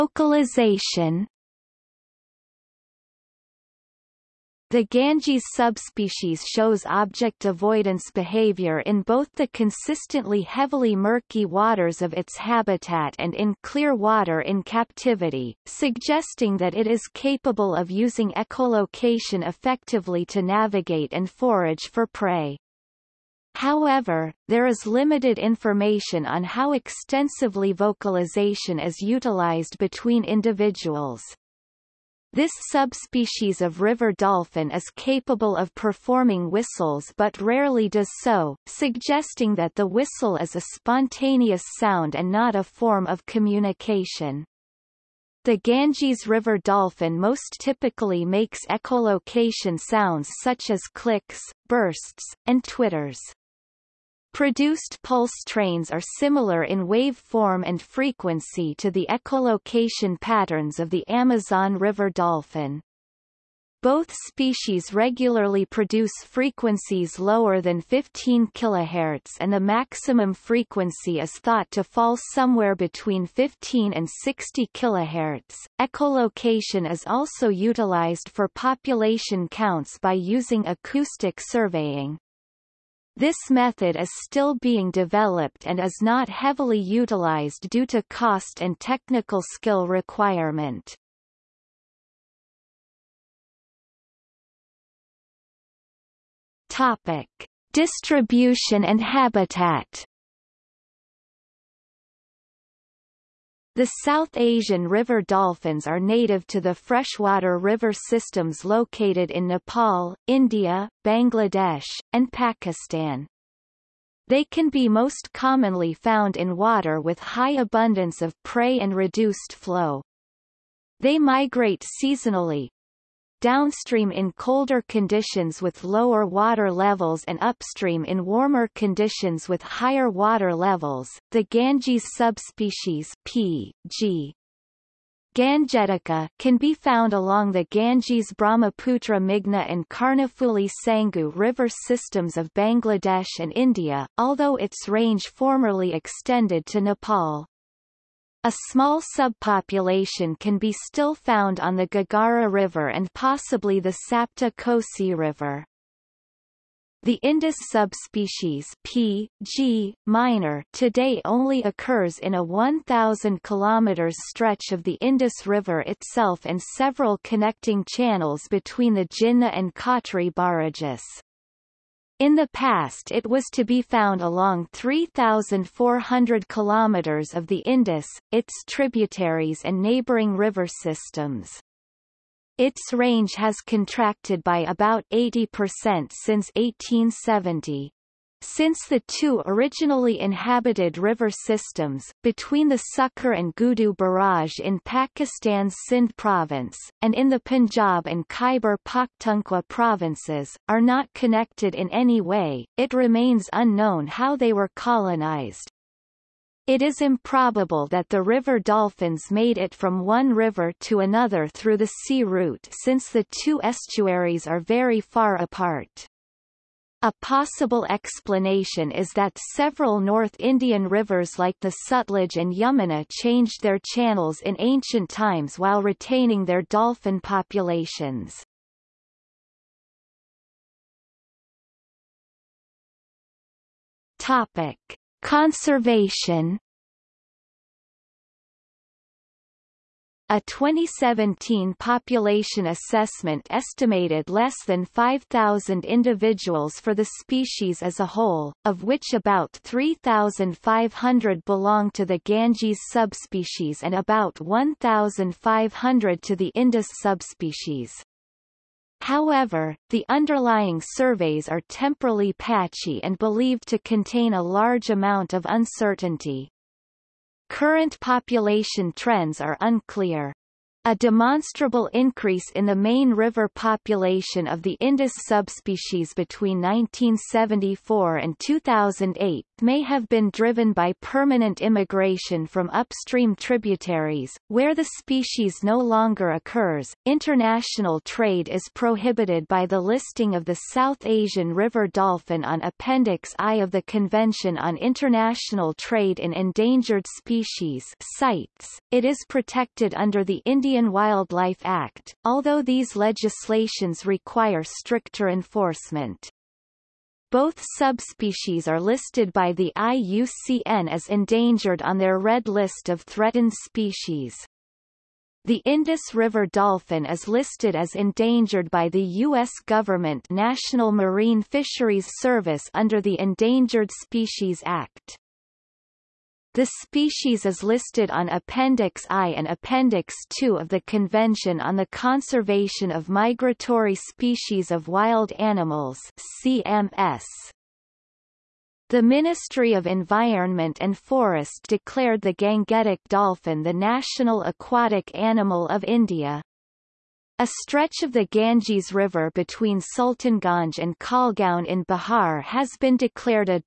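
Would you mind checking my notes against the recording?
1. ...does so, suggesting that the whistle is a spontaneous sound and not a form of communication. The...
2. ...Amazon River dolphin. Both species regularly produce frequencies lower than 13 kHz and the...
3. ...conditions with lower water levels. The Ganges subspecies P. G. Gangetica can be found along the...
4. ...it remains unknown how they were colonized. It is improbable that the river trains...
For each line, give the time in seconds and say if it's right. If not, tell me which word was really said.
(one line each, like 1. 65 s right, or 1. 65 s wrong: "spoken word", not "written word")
1. 37 s right
2. 61 s wrong: "15", not "13"
3. 128 s wrong: "higher", not "lower"
4. 202 s wrong: "dolphins", not "trains".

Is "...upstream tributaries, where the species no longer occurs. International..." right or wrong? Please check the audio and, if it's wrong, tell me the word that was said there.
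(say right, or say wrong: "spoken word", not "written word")
right.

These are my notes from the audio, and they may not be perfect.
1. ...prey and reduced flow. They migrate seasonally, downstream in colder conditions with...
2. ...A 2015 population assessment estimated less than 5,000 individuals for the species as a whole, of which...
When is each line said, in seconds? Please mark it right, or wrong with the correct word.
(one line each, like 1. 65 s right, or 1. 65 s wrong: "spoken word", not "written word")
1. 118 s right
2. 240 s wrong: "2017", not "2015".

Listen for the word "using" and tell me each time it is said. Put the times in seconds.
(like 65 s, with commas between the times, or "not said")
17 s, 80 s.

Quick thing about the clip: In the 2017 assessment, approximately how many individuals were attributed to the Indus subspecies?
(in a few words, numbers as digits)
1,500.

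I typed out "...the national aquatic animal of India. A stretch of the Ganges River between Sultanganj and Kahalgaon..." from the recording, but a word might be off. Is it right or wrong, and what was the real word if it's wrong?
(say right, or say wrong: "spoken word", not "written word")
right.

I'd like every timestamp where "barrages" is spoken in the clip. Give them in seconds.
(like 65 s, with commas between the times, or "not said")
170 s, 193 s.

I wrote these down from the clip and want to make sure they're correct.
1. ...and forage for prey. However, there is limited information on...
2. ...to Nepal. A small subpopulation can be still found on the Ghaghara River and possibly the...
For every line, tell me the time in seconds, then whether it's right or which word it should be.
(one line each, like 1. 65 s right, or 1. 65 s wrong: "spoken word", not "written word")
1. 21 s right
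2. 146 s right.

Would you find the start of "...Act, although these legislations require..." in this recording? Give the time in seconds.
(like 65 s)
301 s.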